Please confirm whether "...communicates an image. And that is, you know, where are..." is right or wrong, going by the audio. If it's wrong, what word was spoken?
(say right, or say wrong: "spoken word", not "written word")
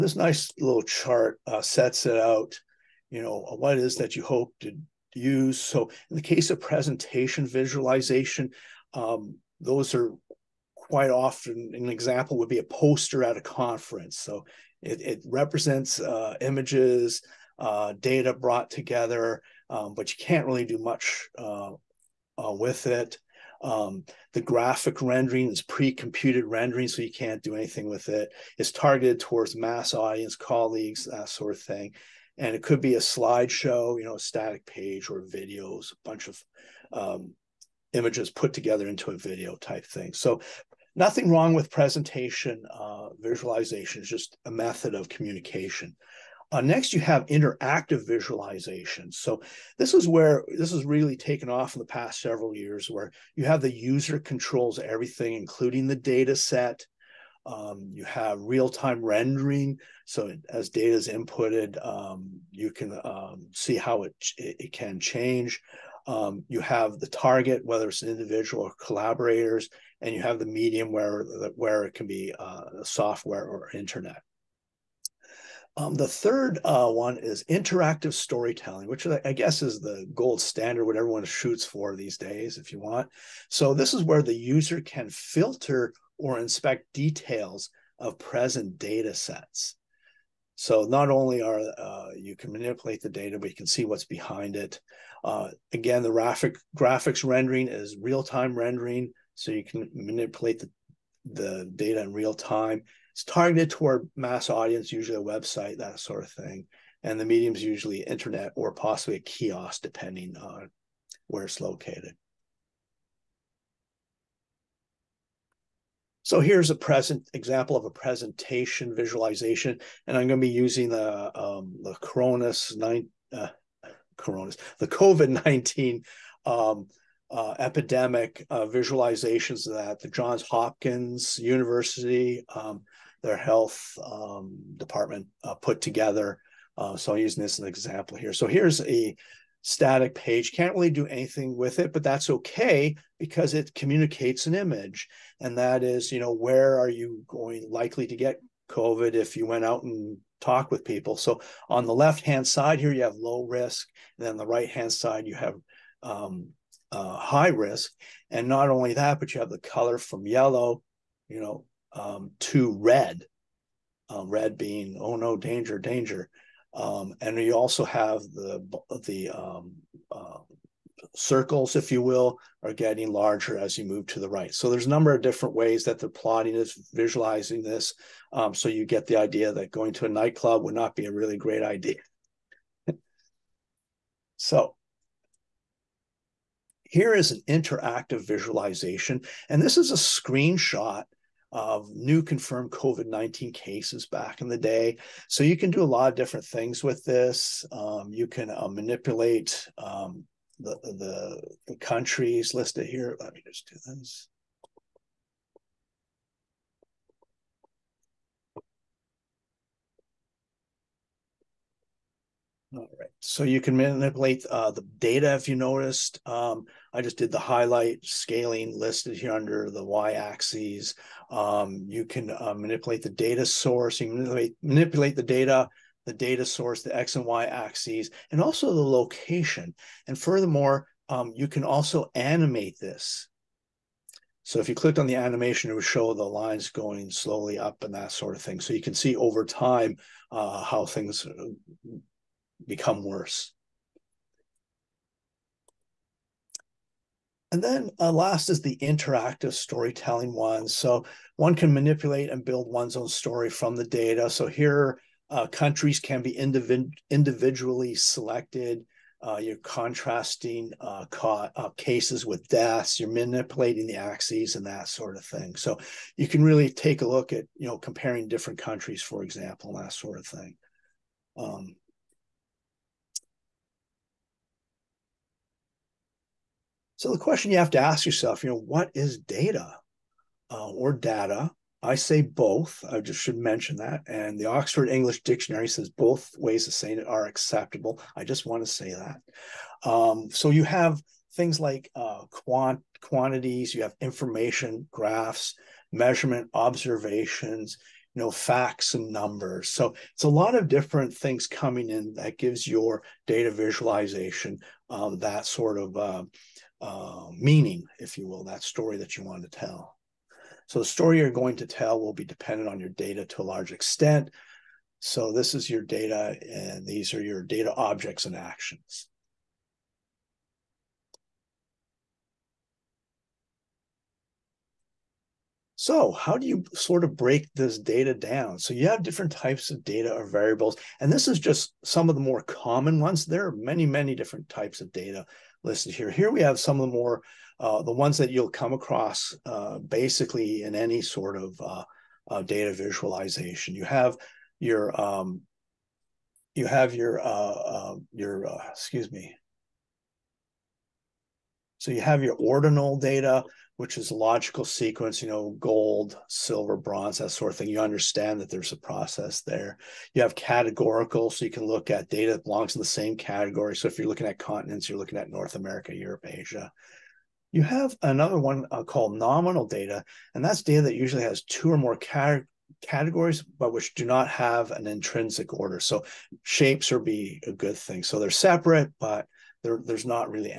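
right.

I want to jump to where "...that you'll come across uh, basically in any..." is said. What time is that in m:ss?
5:38.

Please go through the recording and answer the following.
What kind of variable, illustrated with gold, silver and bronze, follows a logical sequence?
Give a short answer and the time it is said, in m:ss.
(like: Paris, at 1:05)
ordinal data, at 5:52.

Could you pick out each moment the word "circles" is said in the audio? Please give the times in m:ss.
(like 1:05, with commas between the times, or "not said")
2:51.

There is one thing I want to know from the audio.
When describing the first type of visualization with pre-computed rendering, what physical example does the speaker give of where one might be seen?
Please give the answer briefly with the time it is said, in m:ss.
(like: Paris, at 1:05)
a poster at a conference, at 0:12.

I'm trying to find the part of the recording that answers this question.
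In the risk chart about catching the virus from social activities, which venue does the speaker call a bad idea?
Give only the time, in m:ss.
3:00.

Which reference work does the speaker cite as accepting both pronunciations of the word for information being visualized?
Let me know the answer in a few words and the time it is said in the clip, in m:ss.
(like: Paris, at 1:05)
Oxford English Dictionary, at 4:44.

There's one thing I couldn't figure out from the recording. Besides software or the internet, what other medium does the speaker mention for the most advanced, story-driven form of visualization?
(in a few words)
a kiosk.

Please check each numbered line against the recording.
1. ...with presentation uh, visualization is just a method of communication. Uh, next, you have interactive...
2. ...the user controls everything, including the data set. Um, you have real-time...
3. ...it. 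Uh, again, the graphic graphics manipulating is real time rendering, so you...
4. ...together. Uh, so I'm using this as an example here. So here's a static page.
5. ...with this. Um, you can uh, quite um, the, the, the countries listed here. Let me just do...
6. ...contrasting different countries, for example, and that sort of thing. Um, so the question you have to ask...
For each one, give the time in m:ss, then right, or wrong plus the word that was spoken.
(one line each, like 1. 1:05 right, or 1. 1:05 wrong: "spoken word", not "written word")
1. 0:41 right
2. 0:53 right
3. 1:34 wrong: "rendering", not "manipulating"
4. 2:15 right
5. 3:16 wrong: "manipulate", not "quite"
6. 4:27 wrong: "comparing", not "contrasting".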